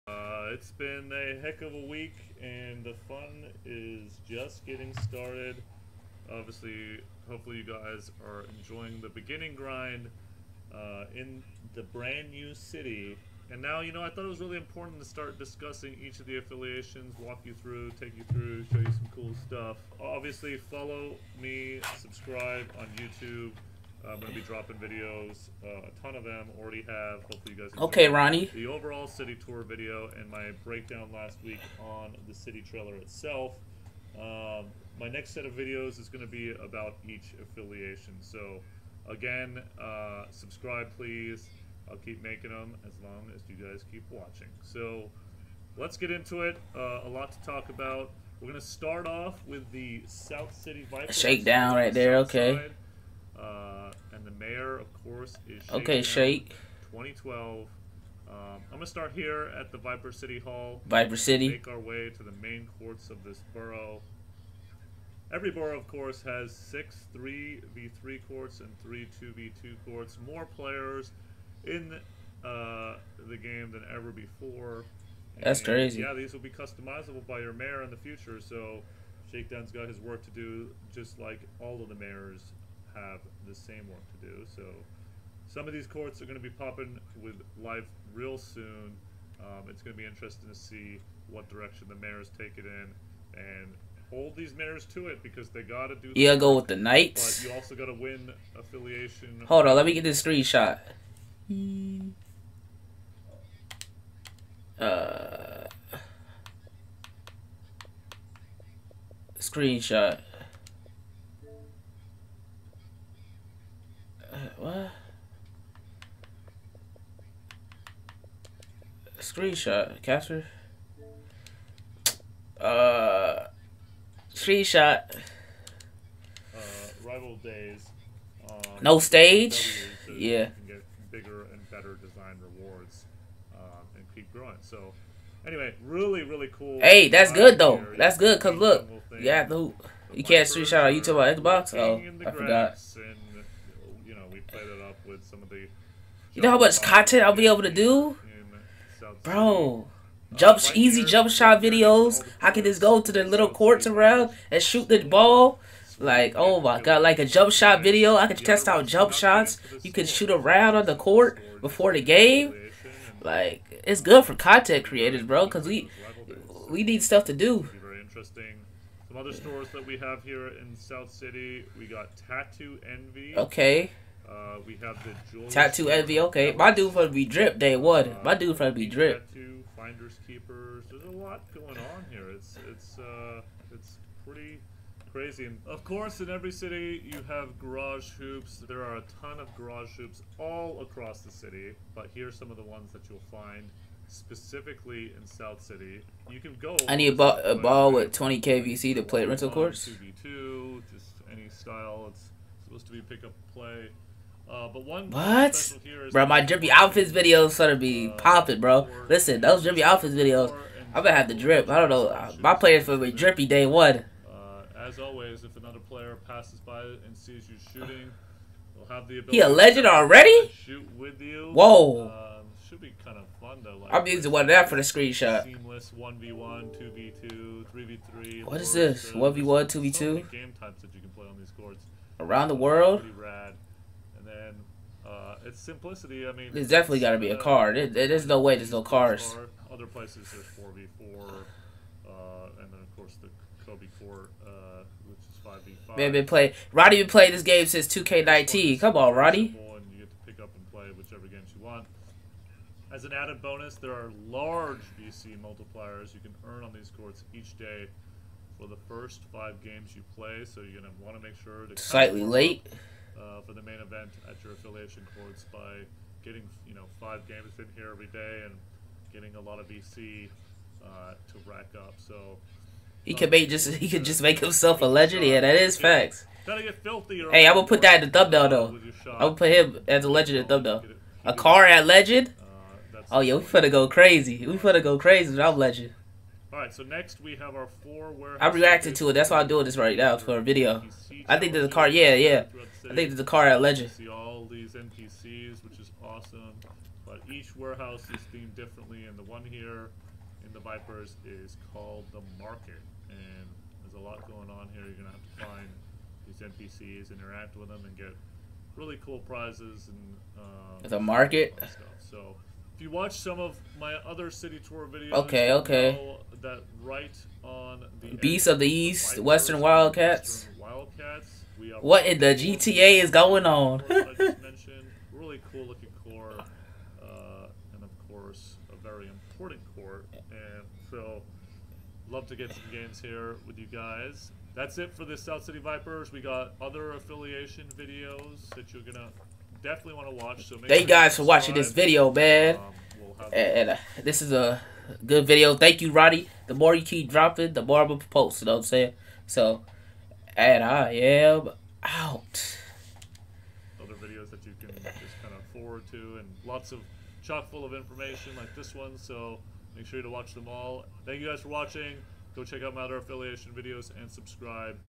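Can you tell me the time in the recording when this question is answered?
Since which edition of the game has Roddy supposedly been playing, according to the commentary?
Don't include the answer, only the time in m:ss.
4:07.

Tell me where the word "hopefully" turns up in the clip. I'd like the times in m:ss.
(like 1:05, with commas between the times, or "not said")
0:07, 0:27.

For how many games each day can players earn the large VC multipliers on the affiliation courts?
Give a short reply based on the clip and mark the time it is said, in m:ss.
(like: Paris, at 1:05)
5, at 4:18.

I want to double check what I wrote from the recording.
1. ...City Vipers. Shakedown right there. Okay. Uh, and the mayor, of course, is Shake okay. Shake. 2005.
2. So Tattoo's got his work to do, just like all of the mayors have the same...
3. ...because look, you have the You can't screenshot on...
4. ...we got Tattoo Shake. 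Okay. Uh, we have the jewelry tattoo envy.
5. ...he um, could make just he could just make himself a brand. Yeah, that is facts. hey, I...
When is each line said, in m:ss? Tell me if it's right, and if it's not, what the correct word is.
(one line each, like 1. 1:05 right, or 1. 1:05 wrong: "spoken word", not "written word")
1. 0:50 wrong: "2012", not "2005"
2. 1:18 wrong: "Shakedown", not "Tattoo"
3. 2:18 right
4. 2:51 wrong: "Envy", not "Shake"
5. 4:33 wrong: "legend", not "brand".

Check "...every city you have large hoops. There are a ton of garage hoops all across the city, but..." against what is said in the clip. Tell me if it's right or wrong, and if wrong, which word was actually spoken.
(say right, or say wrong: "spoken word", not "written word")
wrong: "garage", not "large".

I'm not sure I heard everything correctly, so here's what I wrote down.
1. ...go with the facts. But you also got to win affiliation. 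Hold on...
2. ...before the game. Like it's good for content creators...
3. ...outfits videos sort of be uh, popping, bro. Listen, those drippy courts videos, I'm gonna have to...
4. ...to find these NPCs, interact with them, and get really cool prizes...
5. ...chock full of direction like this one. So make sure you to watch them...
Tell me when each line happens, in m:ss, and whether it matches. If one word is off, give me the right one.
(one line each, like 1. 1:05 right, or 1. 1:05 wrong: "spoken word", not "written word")
1. 1:36 wrong: "knights", not "facts"
2. 2:41 right
3. 3:26 wrong: "outfits", not "courts"
4. 5:05 right
5. 5:57 wrong: "information", not "direction".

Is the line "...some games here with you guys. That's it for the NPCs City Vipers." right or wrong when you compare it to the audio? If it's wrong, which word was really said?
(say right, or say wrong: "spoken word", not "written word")
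wrong: "South", not "NPCs".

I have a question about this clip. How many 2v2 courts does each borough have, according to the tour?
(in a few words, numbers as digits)
3.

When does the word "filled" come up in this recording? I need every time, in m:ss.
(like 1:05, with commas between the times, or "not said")
not said.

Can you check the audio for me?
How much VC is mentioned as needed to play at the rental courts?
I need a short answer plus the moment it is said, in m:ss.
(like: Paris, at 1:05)
20, at 3:18.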